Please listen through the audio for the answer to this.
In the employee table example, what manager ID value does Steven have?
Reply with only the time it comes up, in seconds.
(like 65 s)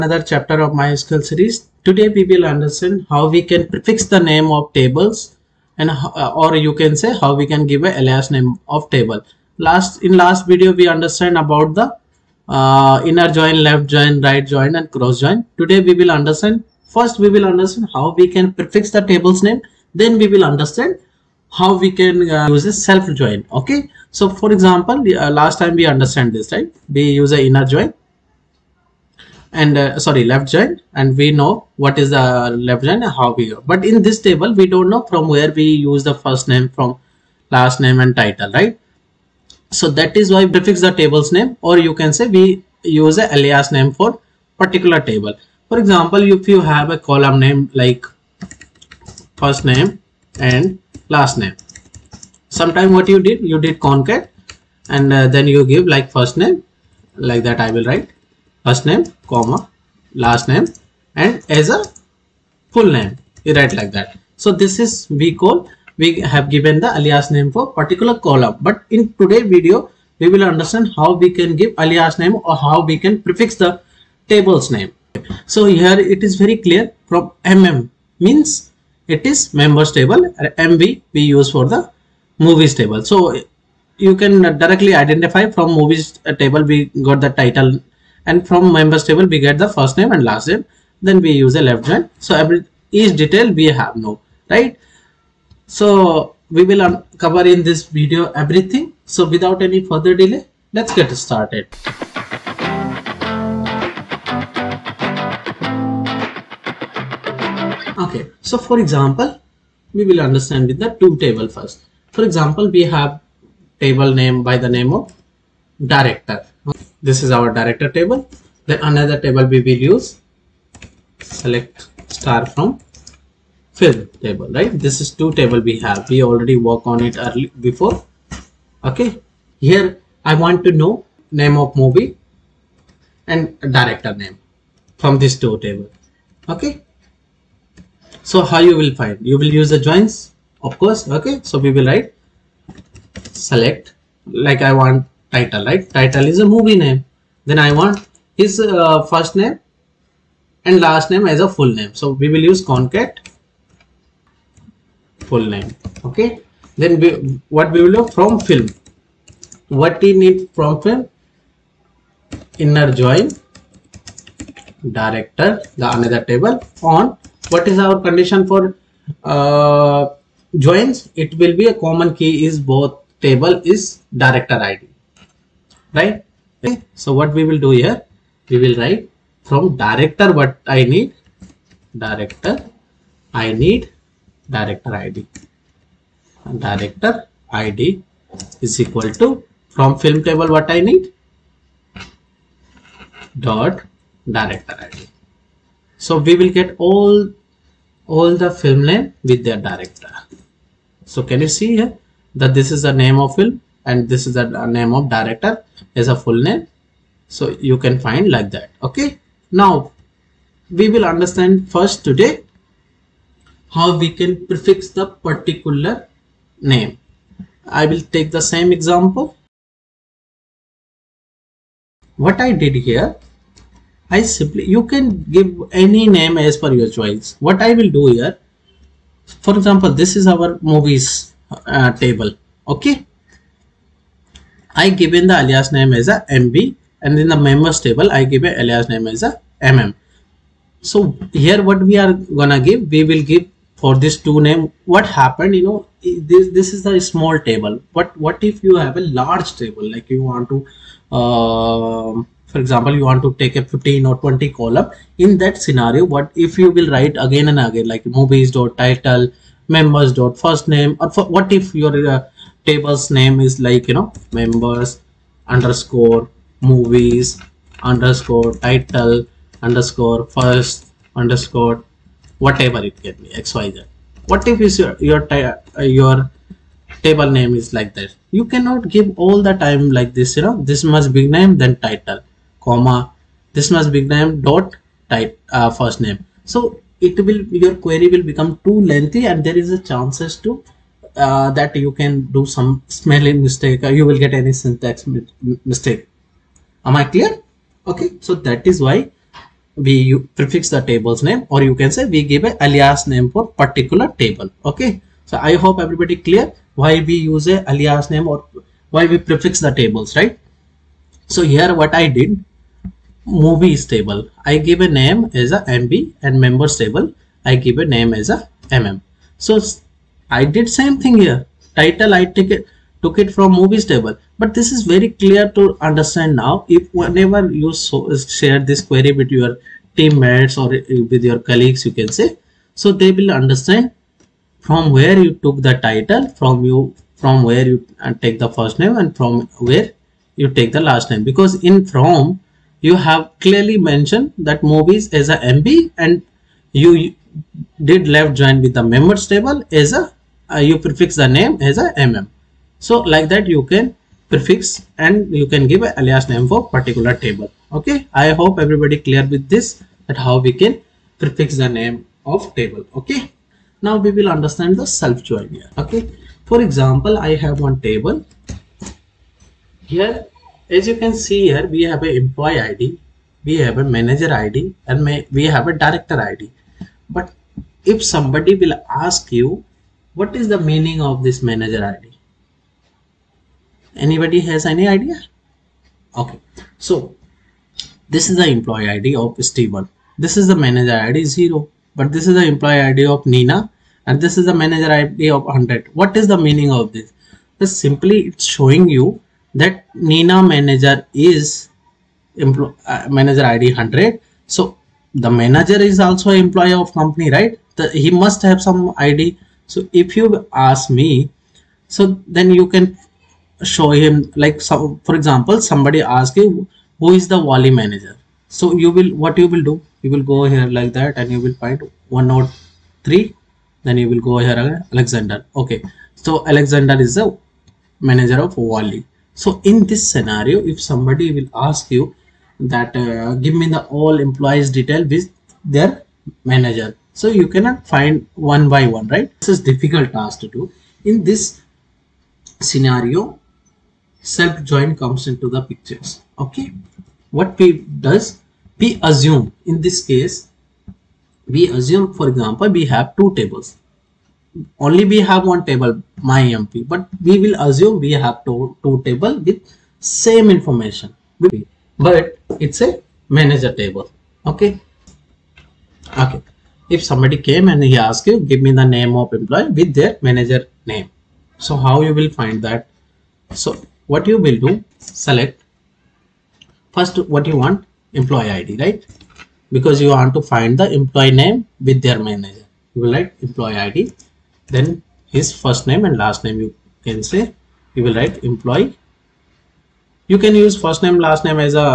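391 s.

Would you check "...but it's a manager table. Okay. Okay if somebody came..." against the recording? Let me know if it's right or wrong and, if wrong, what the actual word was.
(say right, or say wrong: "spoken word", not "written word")
right.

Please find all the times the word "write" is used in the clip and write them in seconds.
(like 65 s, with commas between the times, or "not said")
57 s, 63 s, 141 s, 178 s, 256 s, 483 s, 488 s.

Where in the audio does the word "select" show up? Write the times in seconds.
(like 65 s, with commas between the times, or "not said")
121 s, 143 s, 474 s.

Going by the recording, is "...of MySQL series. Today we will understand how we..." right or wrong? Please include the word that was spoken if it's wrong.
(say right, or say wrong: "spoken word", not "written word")
right.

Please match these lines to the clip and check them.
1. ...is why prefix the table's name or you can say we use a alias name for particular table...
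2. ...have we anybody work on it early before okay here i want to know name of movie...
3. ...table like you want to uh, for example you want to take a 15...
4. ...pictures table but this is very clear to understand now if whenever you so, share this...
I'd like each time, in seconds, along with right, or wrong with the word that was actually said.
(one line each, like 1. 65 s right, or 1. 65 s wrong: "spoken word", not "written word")
1. 40 s right
2. 125 s wrong: "already", not "anybody"
3. 249 s right
4. 323 s wrong: "movies", not "pictures".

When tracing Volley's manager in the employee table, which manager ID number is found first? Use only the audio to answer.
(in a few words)
103.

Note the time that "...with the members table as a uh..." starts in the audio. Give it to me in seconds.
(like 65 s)
348 s.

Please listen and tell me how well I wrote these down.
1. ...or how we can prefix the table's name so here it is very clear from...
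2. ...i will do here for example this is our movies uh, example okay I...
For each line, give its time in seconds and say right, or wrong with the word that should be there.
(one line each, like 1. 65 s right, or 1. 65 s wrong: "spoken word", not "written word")
1. 72 s right
2. 227 s wrong: "table", not "example".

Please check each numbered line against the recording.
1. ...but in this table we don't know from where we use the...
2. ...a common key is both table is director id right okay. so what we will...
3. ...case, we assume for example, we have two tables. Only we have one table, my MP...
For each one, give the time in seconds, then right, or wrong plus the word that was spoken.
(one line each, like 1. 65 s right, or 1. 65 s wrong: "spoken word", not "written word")
1. 33 s right
2. 171 s right
3. 450 s right.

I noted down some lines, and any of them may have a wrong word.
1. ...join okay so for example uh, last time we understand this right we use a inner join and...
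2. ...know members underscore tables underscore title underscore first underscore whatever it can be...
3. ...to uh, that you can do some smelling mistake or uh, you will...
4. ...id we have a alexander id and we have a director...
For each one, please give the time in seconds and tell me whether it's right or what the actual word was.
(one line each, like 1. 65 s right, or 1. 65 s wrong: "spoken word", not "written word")
1. 23 s right
2. 263 s wrong: "movies", not "tables"
3. 290 s right
4. 372 s wrong: "manager", not "alexander".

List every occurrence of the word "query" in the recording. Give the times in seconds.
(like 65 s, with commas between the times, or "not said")
287 s, 328 s.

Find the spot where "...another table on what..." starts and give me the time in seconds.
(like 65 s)
165 s.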